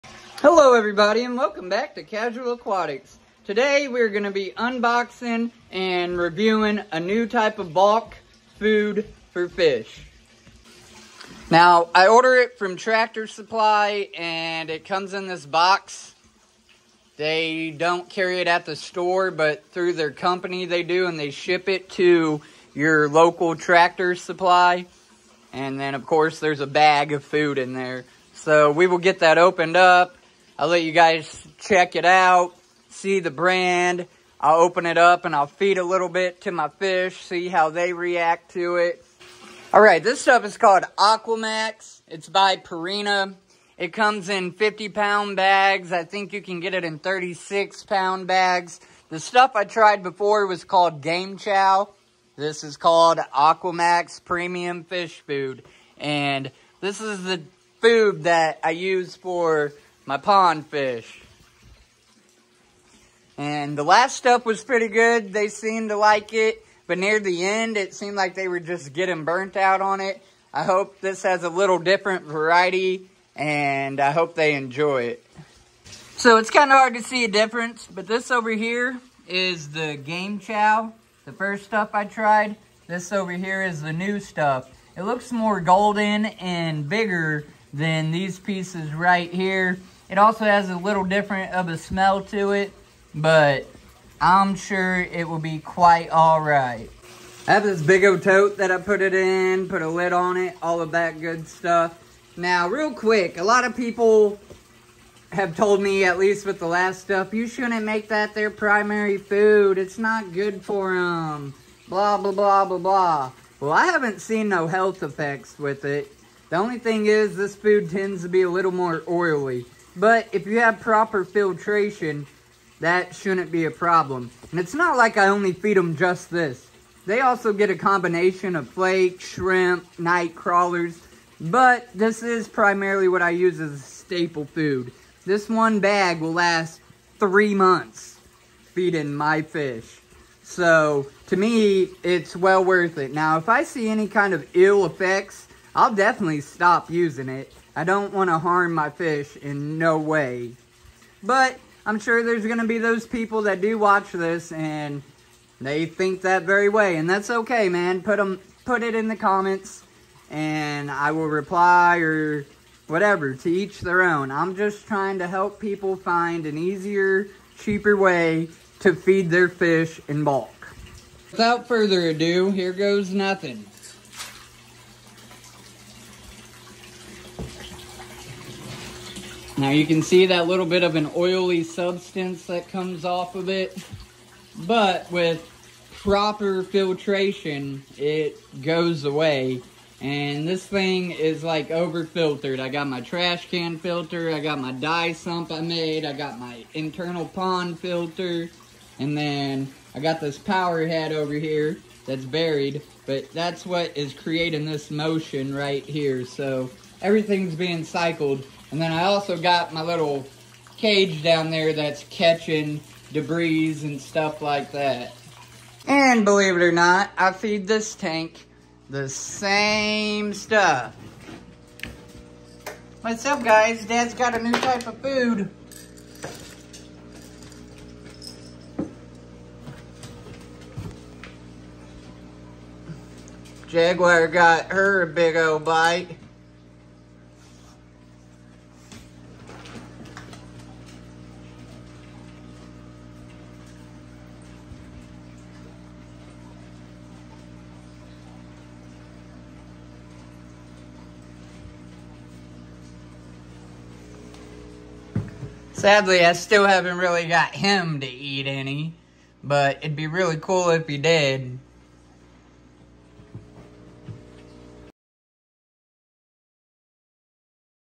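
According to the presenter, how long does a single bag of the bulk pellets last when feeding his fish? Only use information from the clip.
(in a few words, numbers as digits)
3 months.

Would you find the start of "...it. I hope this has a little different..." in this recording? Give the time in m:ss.
1:10.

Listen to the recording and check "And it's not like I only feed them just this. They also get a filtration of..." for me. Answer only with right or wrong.
wrong.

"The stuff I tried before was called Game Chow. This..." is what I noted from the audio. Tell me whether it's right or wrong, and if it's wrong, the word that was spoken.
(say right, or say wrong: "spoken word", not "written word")
right.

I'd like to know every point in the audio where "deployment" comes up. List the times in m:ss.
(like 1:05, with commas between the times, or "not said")
not said.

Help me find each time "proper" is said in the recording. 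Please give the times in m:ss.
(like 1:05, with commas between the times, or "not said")
2:00, 3:05.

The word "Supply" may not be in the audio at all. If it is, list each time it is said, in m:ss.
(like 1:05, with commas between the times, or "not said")
0:13, 0:24.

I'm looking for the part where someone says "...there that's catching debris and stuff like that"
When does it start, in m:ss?
3:31.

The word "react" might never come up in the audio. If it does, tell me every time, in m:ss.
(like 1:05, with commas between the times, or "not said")
0:37.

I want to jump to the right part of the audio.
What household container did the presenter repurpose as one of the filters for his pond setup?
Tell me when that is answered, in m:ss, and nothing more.
3:13.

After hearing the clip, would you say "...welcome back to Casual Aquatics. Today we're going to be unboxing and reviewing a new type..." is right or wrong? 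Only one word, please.
right.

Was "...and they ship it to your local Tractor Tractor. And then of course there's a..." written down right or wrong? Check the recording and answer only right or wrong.
wrong.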